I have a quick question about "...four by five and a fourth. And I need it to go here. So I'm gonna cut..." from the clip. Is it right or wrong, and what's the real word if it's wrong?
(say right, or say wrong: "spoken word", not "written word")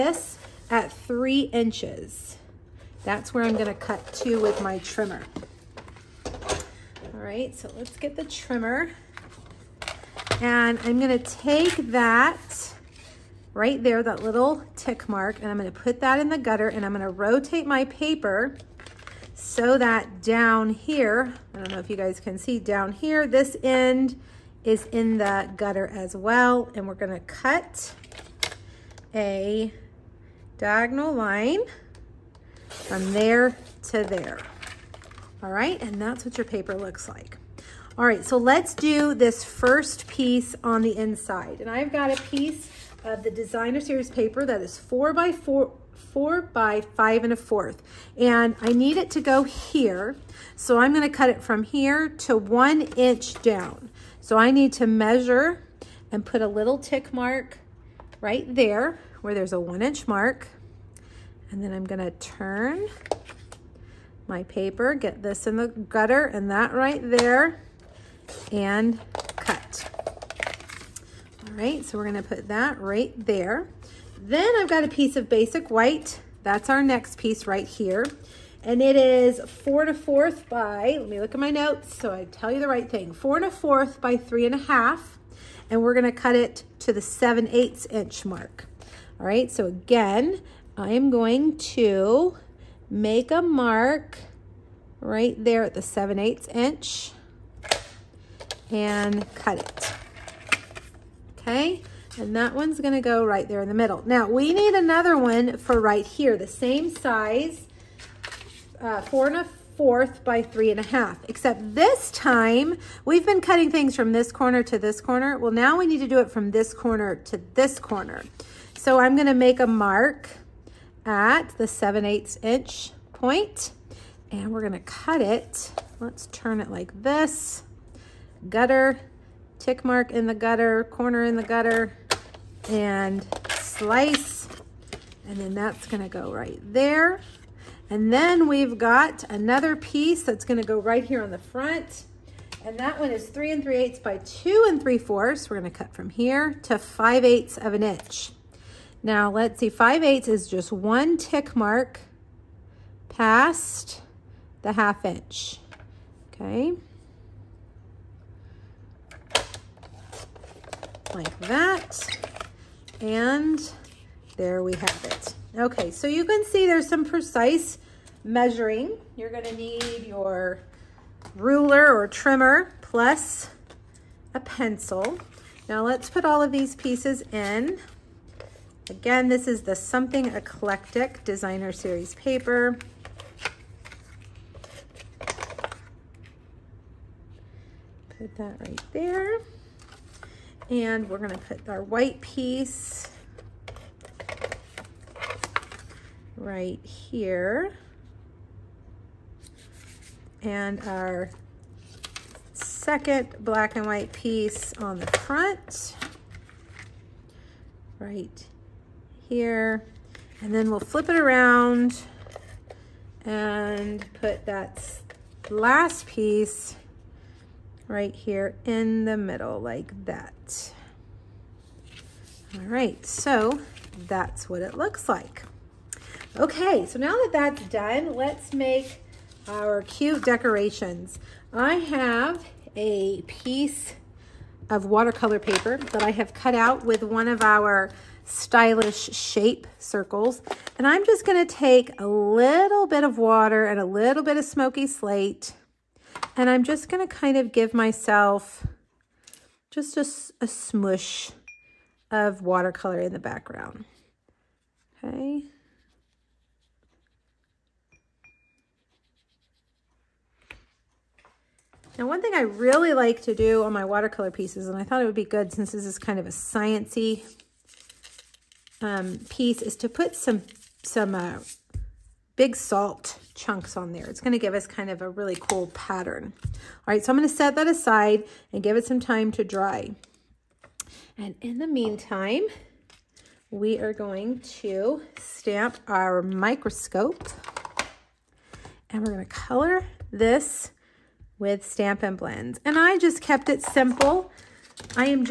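right.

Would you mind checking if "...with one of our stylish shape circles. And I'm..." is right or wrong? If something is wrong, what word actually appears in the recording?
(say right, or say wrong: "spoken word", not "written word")
right.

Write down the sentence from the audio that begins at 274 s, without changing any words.
It's going to give us kind of a really cool pattern.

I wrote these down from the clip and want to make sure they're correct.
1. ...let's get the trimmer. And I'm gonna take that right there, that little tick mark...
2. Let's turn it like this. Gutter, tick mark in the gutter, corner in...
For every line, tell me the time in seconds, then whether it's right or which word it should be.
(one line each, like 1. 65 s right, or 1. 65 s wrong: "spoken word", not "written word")
1. 7 s right
2. 125 s right.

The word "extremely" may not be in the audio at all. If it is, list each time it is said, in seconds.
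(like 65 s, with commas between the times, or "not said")
not said.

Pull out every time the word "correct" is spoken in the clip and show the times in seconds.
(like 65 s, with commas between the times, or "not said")
not said.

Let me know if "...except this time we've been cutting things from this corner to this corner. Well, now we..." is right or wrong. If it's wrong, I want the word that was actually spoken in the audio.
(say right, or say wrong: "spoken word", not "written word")
right.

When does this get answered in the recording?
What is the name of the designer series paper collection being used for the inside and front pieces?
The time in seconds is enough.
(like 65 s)
179 s.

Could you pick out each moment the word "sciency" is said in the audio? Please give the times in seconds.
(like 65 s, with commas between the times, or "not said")
266 s.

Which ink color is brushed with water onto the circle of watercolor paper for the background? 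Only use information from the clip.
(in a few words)
Smoky Slate.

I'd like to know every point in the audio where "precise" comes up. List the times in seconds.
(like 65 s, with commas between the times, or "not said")
167 s.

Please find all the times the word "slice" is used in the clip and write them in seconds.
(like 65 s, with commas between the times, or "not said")
133 s.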